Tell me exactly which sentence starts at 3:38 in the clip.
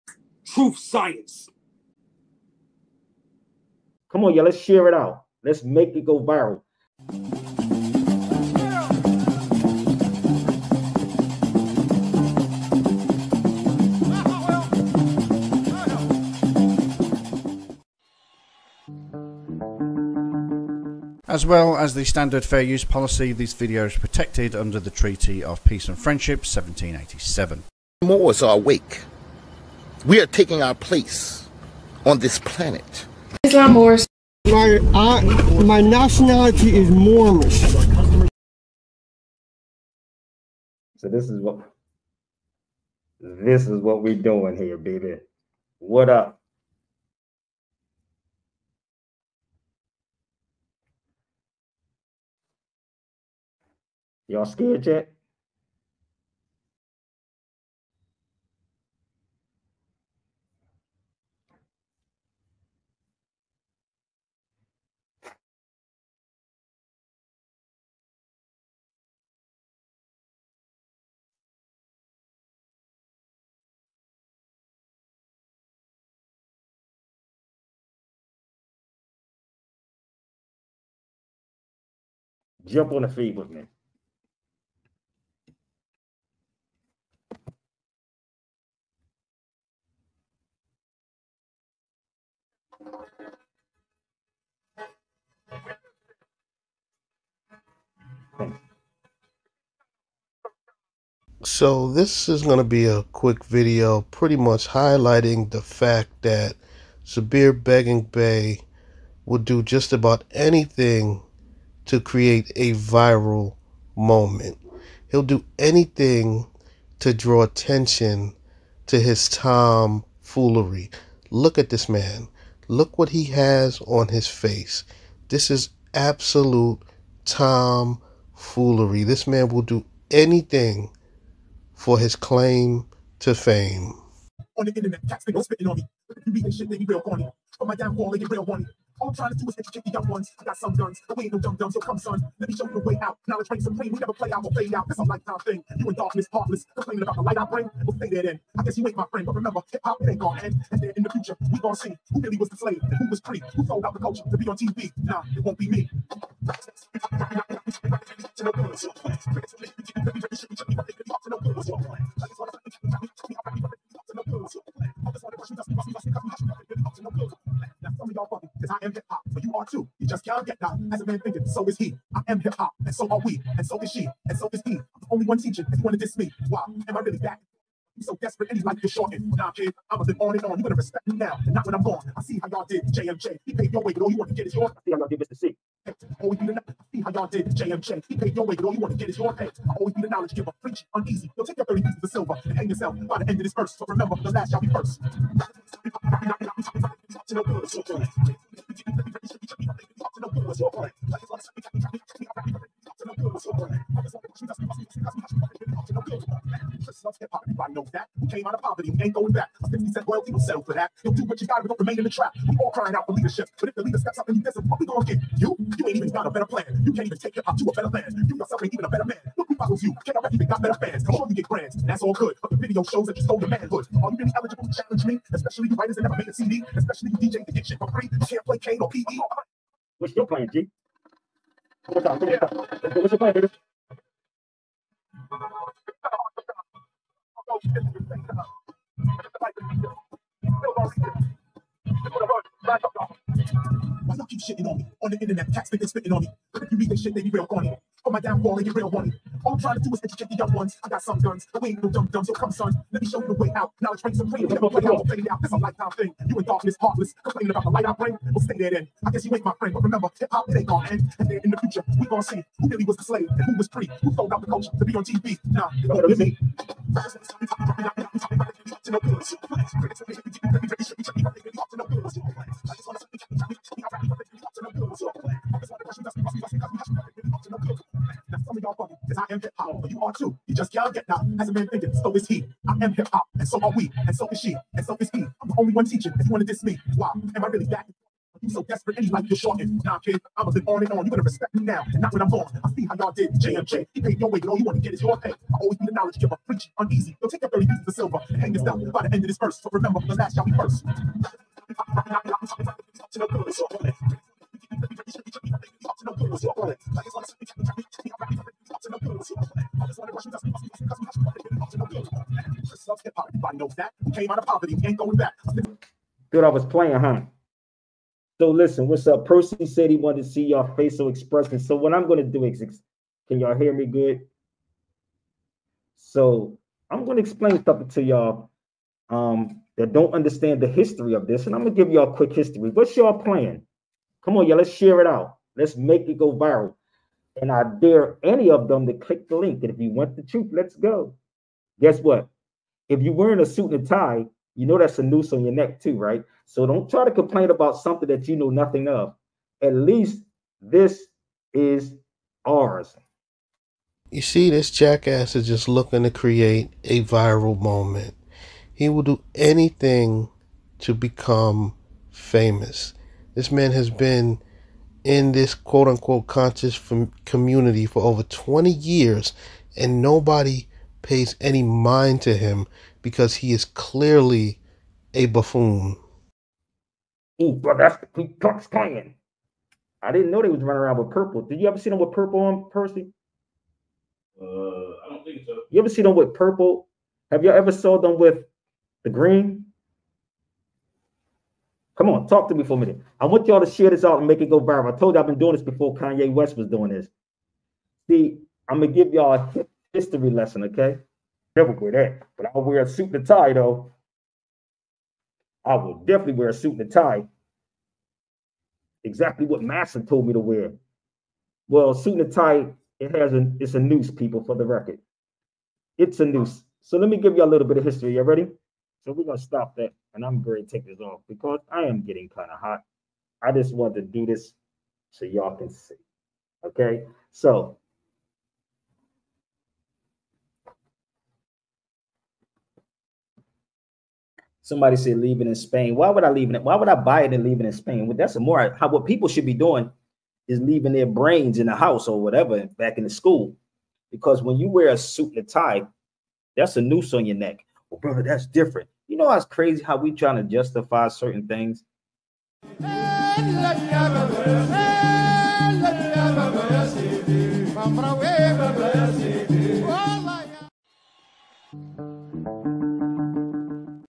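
You yourself ain't even a better man.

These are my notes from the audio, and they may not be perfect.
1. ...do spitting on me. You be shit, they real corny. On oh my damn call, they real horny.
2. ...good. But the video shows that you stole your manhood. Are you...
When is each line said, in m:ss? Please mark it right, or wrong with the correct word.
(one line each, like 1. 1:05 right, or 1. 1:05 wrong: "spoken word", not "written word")
1. 2:15 right
2. 3:42 right.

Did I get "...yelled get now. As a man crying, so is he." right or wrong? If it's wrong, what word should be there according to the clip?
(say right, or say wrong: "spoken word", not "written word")
wrong: "thinking", not "crying".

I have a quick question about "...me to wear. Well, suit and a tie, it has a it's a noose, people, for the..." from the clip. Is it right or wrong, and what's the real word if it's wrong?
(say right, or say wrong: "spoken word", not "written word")
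right.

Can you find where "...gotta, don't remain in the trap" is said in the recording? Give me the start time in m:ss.
3:31.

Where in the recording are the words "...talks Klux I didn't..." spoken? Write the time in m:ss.
6:18.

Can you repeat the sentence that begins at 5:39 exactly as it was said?
And if you want the truth, let's go.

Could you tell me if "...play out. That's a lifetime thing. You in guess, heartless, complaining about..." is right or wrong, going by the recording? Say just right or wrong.
wrong.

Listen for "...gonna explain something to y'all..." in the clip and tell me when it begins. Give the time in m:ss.
5:27.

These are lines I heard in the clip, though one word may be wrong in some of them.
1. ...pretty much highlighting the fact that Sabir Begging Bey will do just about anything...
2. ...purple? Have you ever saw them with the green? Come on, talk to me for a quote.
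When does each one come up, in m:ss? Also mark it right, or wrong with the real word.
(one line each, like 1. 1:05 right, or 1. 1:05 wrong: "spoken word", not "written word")
1. 1:44 right
2. 6:26 wrong: "minute", not "quote".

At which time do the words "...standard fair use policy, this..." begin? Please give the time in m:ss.
0:22.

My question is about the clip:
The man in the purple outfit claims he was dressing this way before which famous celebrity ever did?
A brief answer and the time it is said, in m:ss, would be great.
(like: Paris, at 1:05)
Kanye West, at 6:35.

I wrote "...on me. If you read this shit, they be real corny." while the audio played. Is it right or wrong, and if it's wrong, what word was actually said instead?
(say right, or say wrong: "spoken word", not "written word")
right.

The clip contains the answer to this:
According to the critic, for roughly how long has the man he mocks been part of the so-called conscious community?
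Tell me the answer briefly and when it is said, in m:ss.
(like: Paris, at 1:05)
over 20 years, at 6:08.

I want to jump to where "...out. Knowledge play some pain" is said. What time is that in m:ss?
2:23.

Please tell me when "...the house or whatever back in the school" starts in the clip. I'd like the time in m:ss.
7:21.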